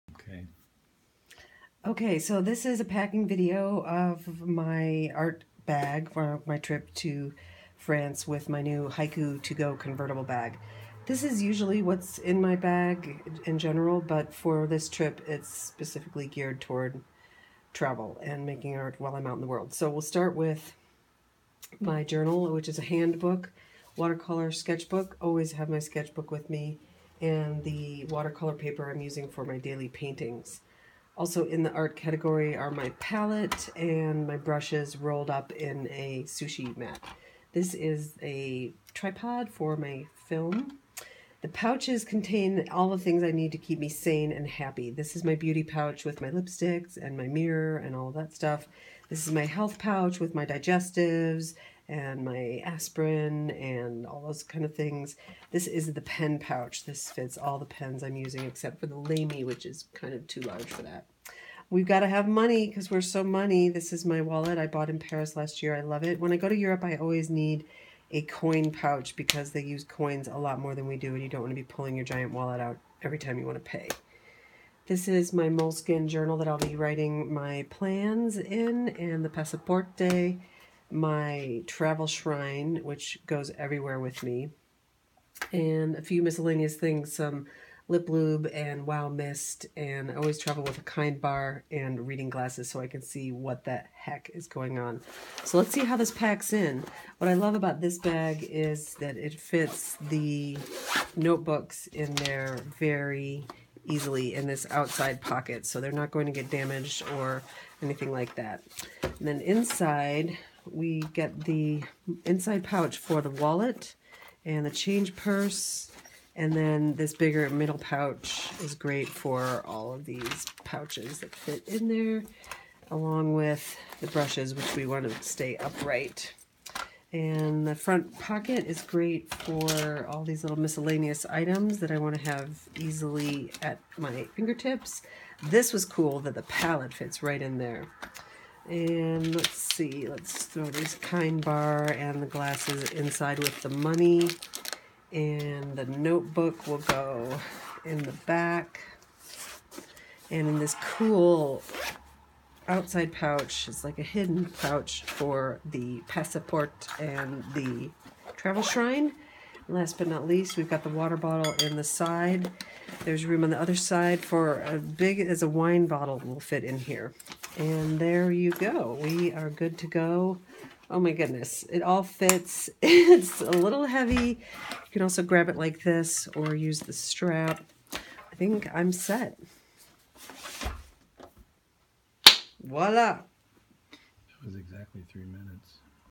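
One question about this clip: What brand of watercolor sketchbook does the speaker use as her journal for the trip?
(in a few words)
Hand Book.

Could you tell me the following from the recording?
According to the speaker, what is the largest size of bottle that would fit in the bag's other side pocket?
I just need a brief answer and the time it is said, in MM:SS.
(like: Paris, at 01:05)
a wine bottle, at 02:45.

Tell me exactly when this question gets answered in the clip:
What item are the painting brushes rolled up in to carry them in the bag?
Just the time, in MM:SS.
00:36.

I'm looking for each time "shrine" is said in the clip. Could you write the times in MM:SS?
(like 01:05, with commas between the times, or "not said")
01:22, 02:38.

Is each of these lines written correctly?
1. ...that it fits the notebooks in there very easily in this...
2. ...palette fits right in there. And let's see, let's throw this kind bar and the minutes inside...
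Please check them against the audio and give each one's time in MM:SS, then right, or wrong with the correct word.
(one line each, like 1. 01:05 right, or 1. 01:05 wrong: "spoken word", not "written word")
1. 01:38 right
2. 02:16 wrong: "glasses", not "minutes".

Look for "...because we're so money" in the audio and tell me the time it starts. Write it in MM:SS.
01:02.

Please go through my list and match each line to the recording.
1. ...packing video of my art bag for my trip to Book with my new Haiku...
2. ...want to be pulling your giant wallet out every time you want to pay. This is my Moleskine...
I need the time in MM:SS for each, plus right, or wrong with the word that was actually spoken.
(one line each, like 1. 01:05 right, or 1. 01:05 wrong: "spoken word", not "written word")
1. 00:02 wrong: "France", not "Book"
2. 01:11 right.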